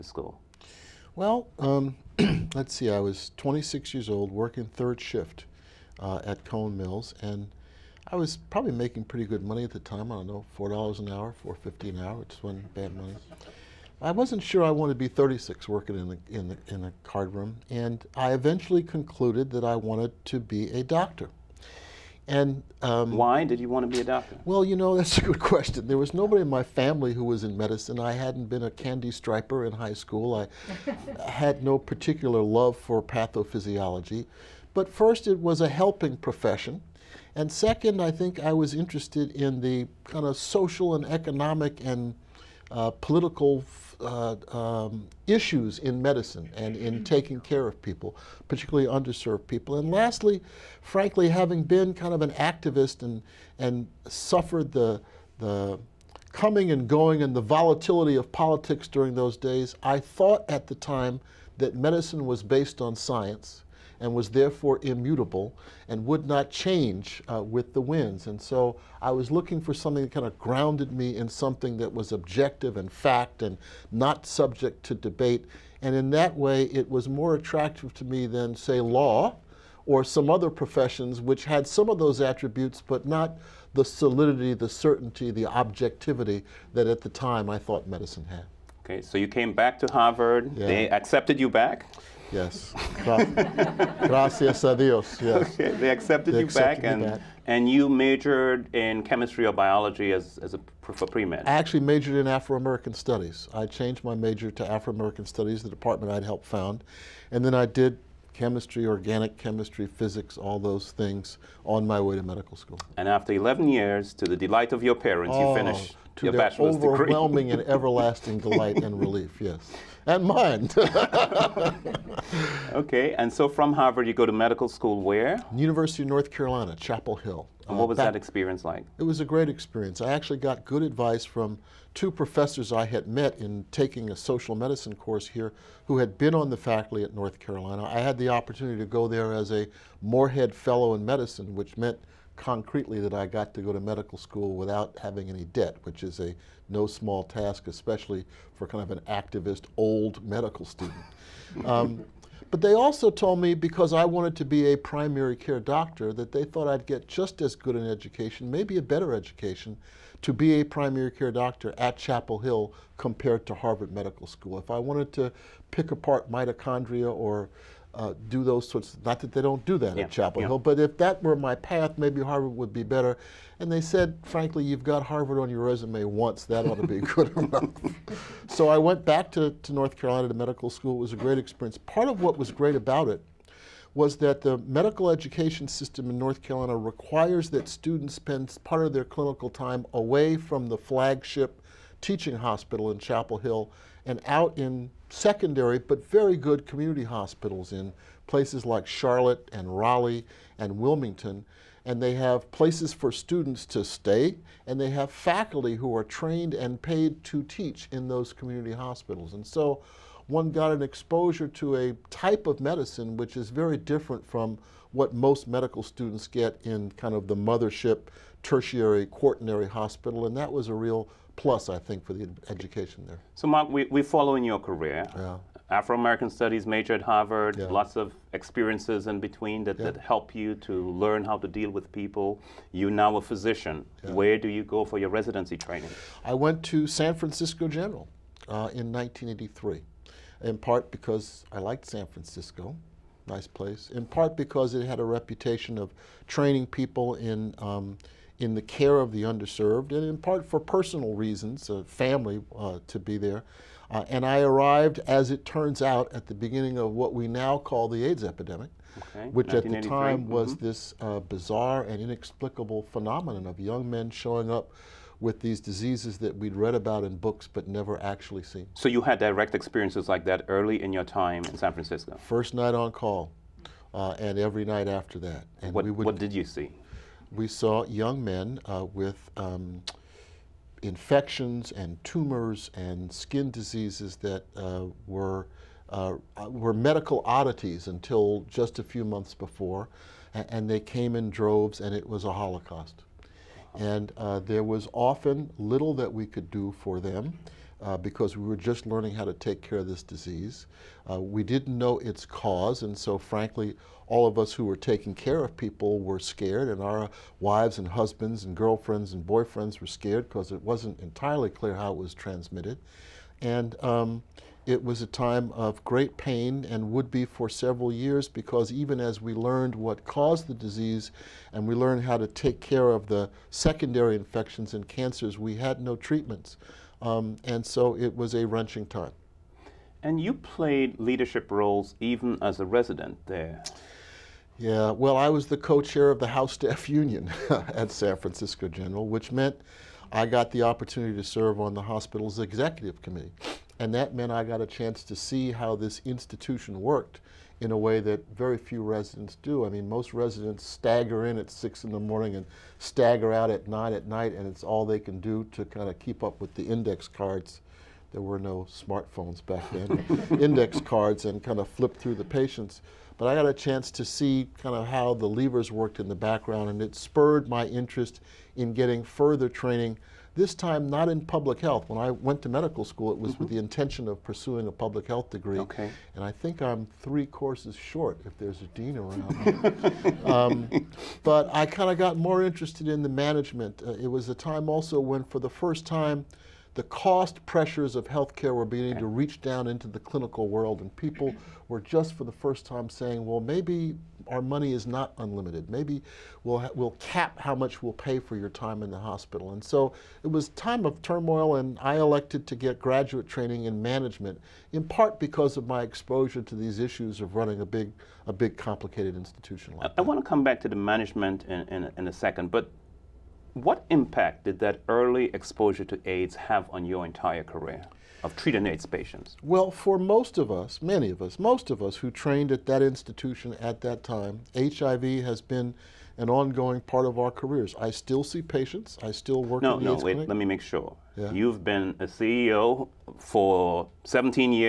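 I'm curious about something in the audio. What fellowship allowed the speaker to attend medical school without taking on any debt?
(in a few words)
Morehead Fellow in Medicine.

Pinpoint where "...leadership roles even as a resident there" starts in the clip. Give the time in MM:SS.
05:30.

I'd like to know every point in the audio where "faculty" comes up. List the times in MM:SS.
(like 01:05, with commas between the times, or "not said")
02:16, 03:25.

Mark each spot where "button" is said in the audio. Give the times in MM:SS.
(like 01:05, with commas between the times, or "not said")
not said.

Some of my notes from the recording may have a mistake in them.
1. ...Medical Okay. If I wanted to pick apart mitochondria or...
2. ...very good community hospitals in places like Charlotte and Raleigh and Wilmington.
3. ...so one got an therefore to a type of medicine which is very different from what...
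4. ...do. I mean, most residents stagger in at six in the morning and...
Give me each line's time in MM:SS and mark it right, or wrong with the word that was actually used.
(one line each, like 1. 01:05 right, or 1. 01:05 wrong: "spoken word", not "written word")
1. 02:43 wrong: "School", not "Okay"
2. 03:16 right
3. 03:29 wrong: "exposure", not "therefore"
4. 05:49 right.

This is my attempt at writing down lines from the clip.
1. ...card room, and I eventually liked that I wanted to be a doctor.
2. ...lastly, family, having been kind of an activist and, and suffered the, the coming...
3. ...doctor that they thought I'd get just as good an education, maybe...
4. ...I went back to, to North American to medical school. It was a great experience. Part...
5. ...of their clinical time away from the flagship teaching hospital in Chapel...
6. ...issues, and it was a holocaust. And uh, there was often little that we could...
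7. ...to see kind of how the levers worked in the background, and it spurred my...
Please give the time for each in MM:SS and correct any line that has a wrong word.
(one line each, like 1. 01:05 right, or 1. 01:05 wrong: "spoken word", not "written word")
1. 00:17 wrong: "concluded", not "liked"
2. 00:49 wrong: "frankly", not "family"
3. 02:35 right
4. 02:58 wrong: "Carolina", not "American"
5. 03:08 right
6. 04:51 wrong: "droves", not "issues"
7. 06:03 right.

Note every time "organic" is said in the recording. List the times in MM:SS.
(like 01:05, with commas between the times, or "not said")
01:48.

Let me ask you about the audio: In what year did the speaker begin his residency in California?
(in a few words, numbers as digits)
1983.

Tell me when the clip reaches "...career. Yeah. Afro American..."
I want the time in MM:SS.
03:44.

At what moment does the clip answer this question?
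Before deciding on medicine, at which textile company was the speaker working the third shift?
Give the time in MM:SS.
00:06.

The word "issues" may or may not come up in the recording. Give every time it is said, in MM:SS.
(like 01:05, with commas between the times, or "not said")
00:45, 06:46.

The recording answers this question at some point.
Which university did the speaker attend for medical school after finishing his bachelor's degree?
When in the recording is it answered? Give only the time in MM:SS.
02:05.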